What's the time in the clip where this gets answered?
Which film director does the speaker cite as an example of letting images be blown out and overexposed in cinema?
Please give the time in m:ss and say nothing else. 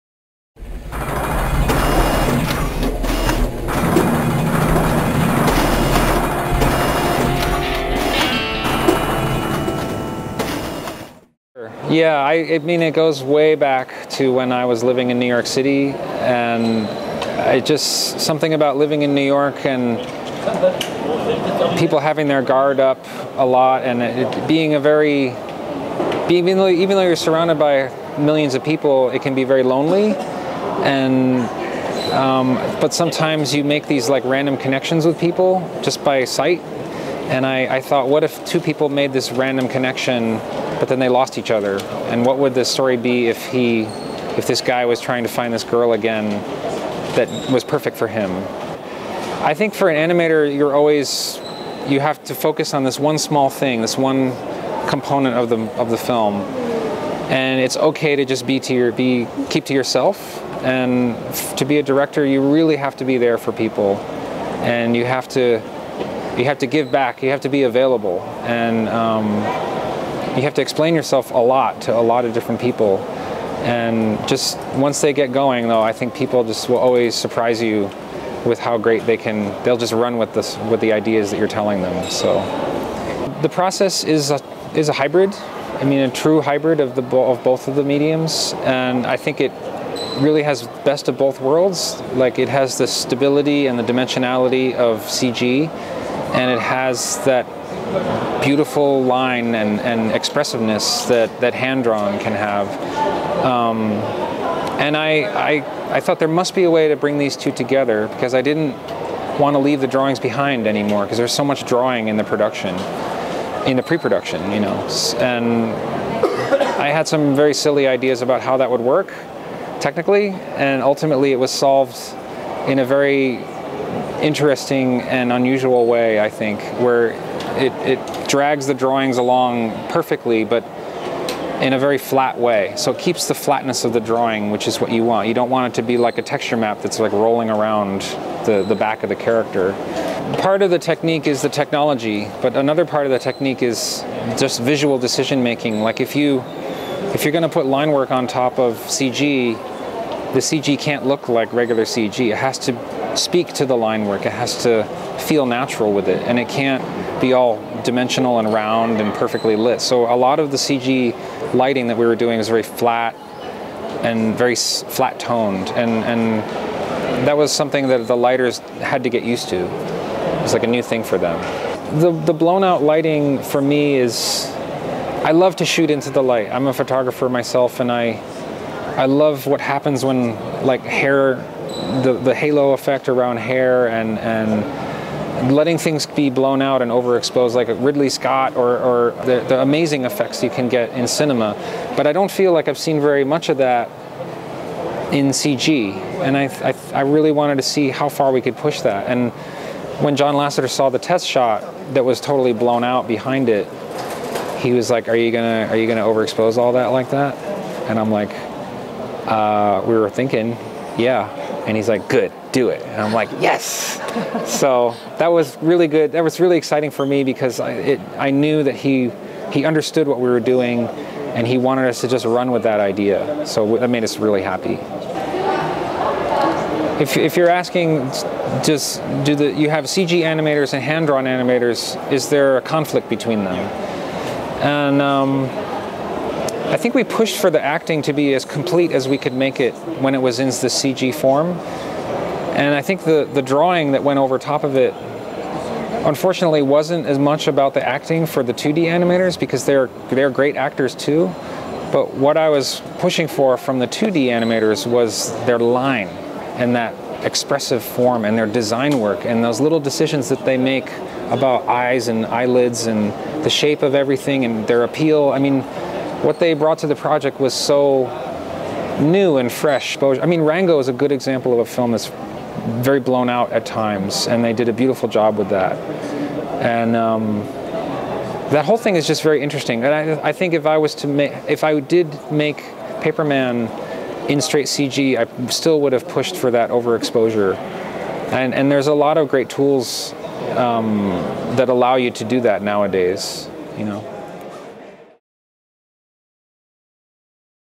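3:07.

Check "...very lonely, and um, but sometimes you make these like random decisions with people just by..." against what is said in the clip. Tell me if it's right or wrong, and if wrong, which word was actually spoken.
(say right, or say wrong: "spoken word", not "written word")
wrong: "connections", not "decisions".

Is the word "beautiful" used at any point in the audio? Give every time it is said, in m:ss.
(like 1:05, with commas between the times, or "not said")
1:38, 4:34.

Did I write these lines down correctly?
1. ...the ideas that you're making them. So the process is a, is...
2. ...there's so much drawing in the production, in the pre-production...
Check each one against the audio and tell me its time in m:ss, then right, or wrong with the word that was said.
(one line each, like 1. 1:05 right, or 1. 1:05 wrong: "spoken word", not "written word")
1. 1:20 wrong: "telling", not "making"
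2. 1:51 right.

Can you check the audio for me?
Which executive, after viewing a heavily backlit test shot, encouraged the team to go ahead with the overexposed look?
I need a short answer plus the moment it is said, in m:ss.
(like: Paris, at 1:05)
John Lasseter, at 3:20.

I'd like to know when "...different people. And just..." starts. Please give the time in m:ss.
1:12.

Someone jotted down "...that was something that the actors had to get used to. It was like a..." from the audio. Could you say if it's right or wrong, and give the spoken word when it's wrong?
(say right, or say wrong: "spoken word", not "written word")
wrong: "lighters", not "actors".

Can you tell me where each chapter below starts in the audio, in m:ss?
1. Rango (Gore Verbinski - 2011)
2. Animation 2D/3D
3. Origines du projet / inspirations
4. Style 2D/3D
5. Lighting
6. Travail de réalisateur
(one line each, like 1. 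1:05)
1. 4:29
2. 3:45
3. 0:16
4. 1:22
5. 2:51
6. 0:49.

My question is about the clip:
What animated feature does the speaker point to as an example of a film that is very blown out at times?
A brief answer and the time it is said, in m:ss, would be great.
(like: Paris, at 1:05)
Rango, at 4:30.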